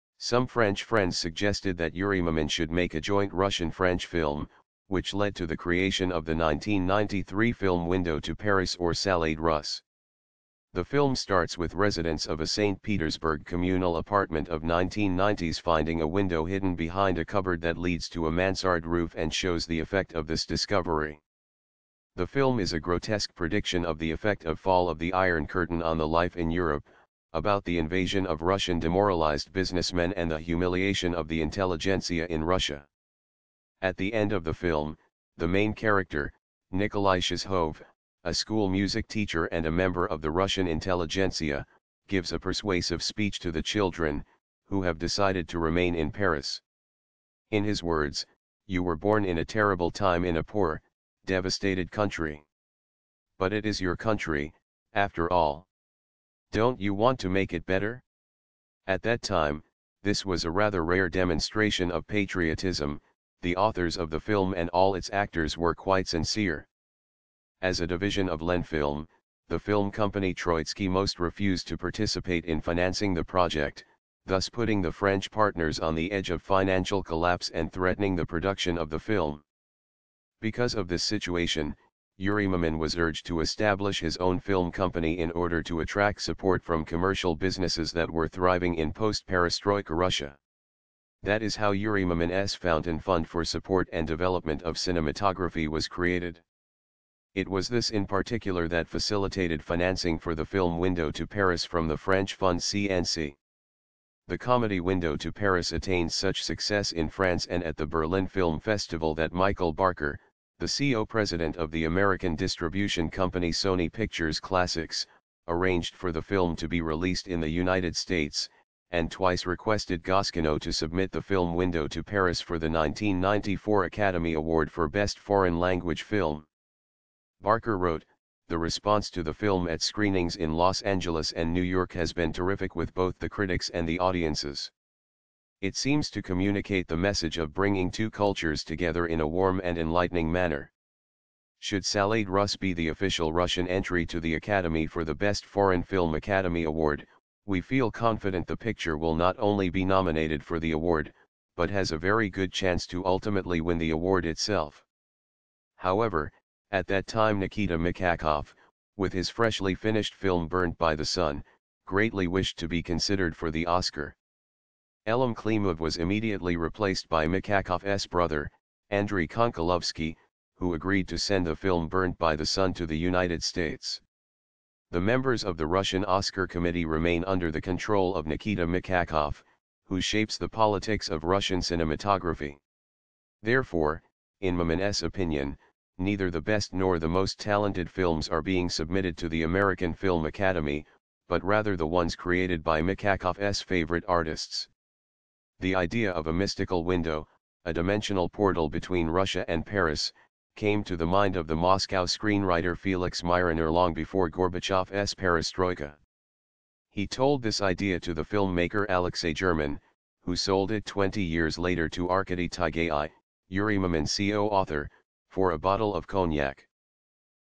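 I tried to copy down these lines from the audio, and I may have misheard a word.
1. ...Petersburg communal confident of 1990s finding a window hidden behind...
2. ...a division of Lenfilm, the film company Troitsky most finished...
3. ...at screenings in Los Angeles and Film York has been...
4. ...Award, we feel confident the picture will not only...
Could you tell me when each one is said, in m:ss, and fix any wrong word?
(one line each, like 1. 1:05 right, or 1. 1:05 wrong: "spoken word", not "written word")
1. 0:12 wrong: "apartment", not "confident"
2. 1:07 wrong: "refused", not "finished"
3. 2:09 wrong: "New", not "Film"
4. 2:26 right.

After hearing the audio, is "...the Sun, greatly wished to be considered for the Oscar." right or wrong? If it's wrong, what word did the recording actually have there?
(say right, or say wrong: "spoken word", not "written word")
right.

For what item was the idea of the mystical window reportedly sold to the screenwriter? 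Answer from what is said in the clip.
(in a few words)
a bottle of cognac.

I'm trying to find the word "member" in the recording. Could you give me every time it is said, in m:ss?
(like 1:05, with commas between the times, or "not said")
0:39, 2:55.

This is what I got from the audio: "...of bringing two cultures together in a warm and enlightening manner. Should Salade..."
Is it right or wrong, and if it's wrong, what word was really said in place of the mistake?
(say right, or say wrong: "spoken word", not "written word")
right.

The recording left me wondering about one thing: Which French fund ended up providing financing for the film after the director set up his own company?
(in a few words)
CNC.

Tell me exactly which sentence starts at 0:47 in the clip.
In his words, you were born in a terrible time in a poor, devastated country.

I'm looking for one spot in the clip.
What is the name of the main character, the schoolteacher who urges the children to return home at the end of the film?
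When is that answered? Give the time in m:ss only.
0:36.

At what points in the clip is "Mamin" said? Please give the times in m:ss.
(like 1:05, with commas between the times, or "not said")
0:02, 1:22, 1:32, 3:04, 3:33.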